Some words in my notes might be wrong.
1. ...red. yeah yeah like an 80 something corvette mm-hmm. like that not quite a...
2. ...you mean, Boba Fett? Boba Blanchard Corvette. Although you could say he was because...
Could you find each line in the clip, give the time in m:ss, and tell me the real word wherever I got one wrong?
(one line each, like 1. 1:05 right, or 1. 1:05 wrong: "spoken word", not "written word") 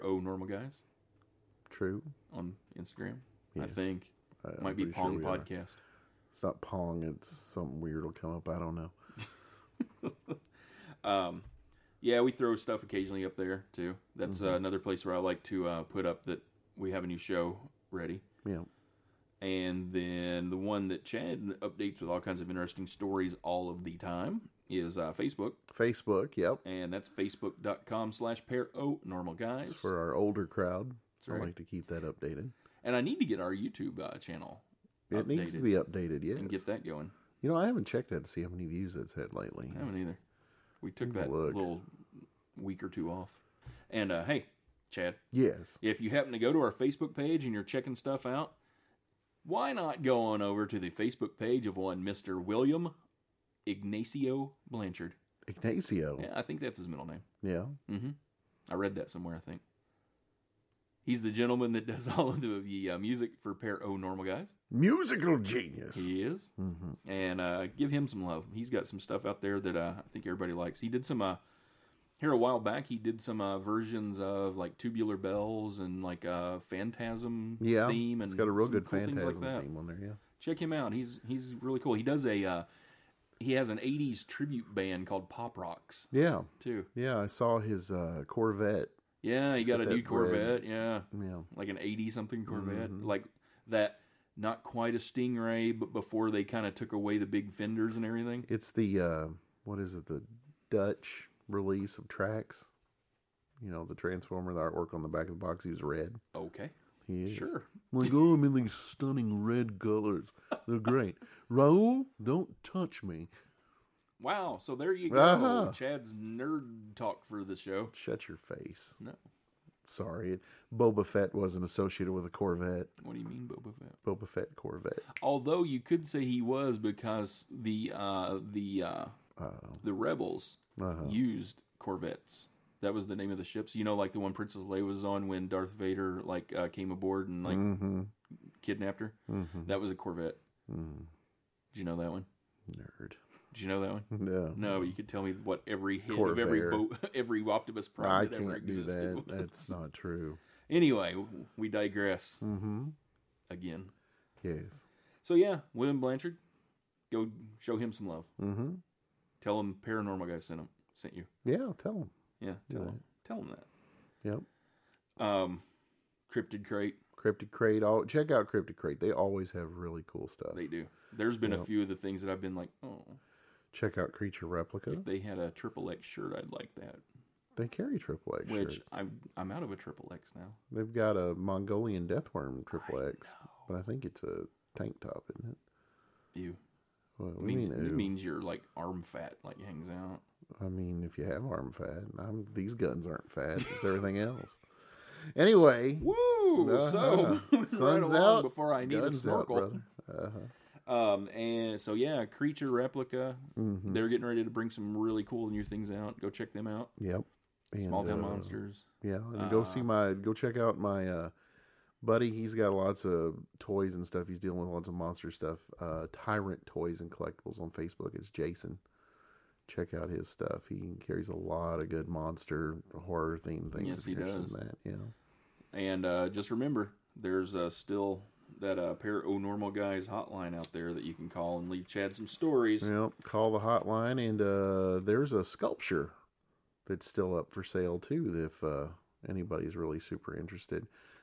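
1. 1:30 right
2. 2:03 wrong: "Fett", not "Blanchard".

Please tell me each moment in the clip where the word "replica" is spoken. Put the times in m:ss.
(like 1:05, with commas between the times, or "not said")
2:54, 3:22.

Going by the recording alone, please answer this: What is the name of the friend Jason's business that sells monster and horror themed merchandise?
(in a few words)
Tyrant Toys and Collectibles.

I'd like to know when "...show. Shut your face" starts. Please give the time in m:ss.
1:57.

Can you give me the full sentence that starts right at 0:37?
You know, I haven't checked that to see how many views it's had lately.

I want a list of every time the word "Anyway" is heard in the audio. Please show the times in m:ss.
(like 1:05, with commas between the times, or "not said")
2:30, 3:15.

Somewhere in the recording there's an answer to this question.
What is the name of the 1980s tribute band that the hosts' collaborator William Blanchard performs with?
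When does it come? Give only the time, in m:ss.
1:25.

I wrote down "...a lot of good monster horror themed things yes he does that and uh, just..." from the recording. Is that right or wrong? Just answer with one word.
right.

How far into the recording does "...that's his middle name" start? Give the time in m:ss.
0:56.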